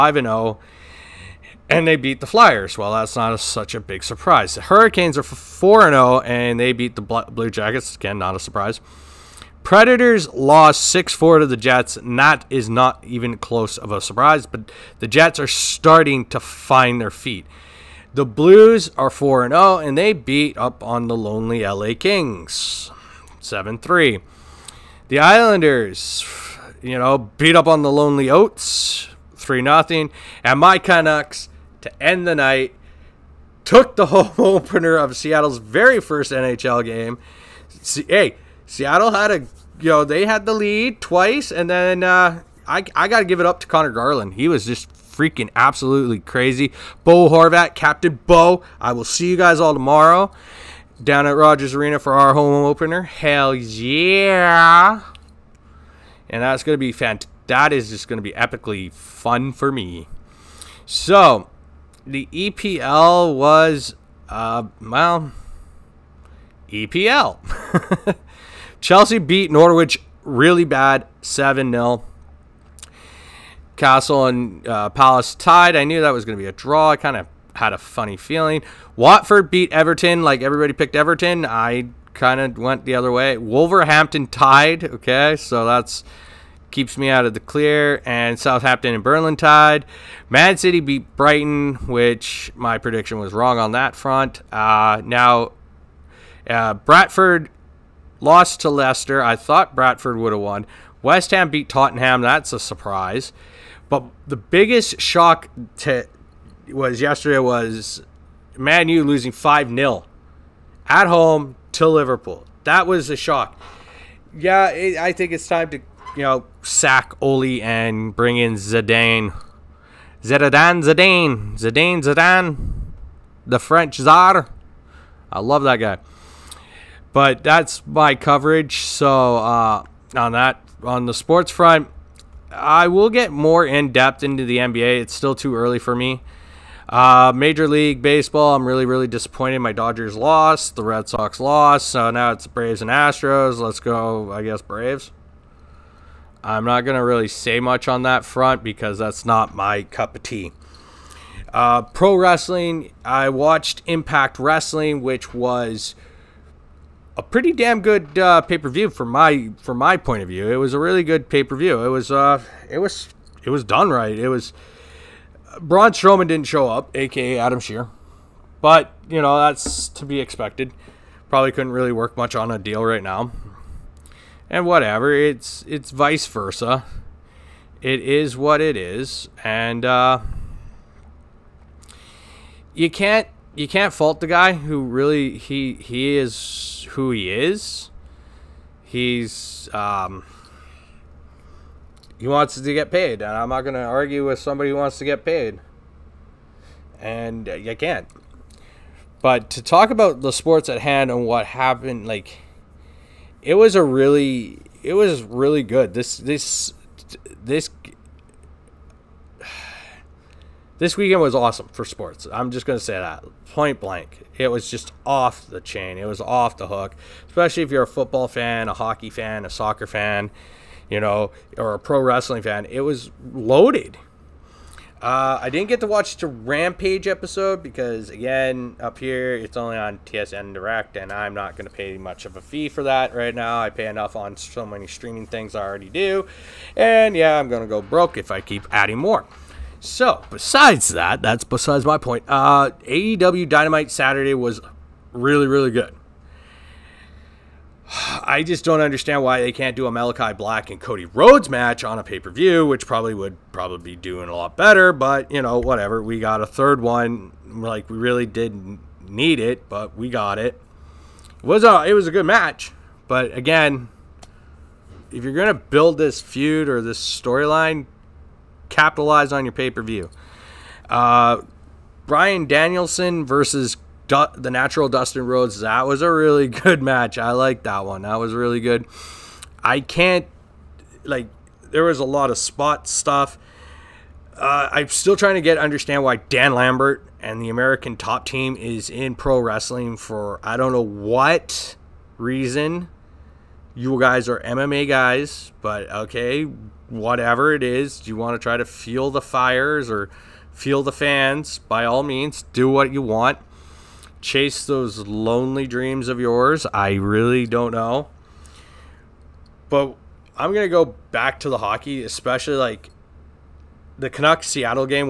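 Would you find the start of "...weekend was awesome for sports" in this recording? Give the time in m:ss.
3:30.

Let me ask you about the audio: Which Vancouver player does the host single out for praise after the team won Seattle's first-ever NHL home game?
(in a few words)
Conor Garland.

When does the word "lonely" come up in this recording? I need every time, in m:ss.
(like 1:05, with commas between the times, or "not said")
0:21, 0:27, 5:04.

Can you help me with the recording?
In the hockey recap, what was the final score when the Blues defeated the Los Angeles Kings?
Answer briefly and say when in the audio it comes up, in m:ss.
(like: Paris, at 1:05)
7-3, at 0:23.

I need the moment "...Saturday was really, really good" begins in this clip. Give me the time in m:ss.
4:03.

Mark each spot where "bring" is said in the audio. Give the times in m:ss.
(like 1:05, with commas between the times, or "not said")
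1:58.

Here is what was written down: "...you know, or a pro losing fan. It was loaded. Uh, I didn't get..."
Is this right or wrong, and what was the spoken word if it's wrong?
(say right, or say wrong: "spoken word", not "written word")
wrong: "wrestling", not "losing".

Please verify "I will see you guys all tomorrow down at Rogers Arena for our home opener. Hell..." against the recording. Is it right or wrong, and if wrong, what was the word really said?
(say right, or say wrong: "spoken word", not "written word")
right.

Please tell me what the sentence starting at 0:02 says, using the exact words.
Well, that's not a, such a big surprise.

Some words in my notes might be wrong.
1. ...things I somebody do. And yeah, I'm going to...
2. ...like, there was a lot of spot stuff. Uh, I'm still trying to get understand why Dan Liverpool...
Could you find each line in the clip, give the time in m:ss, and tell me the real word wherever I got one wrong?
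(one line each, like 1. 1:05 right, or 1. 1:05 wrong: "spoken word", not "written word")
1. 3:55 wrong: "already", not "somebody"
2. 4:41 wrong: "Lambert", not "Liverpool".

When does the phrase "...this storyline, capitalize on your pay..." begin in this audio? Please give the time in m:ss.
4:26.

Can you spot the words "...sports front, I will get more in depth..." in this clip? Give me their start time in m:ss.
2:11.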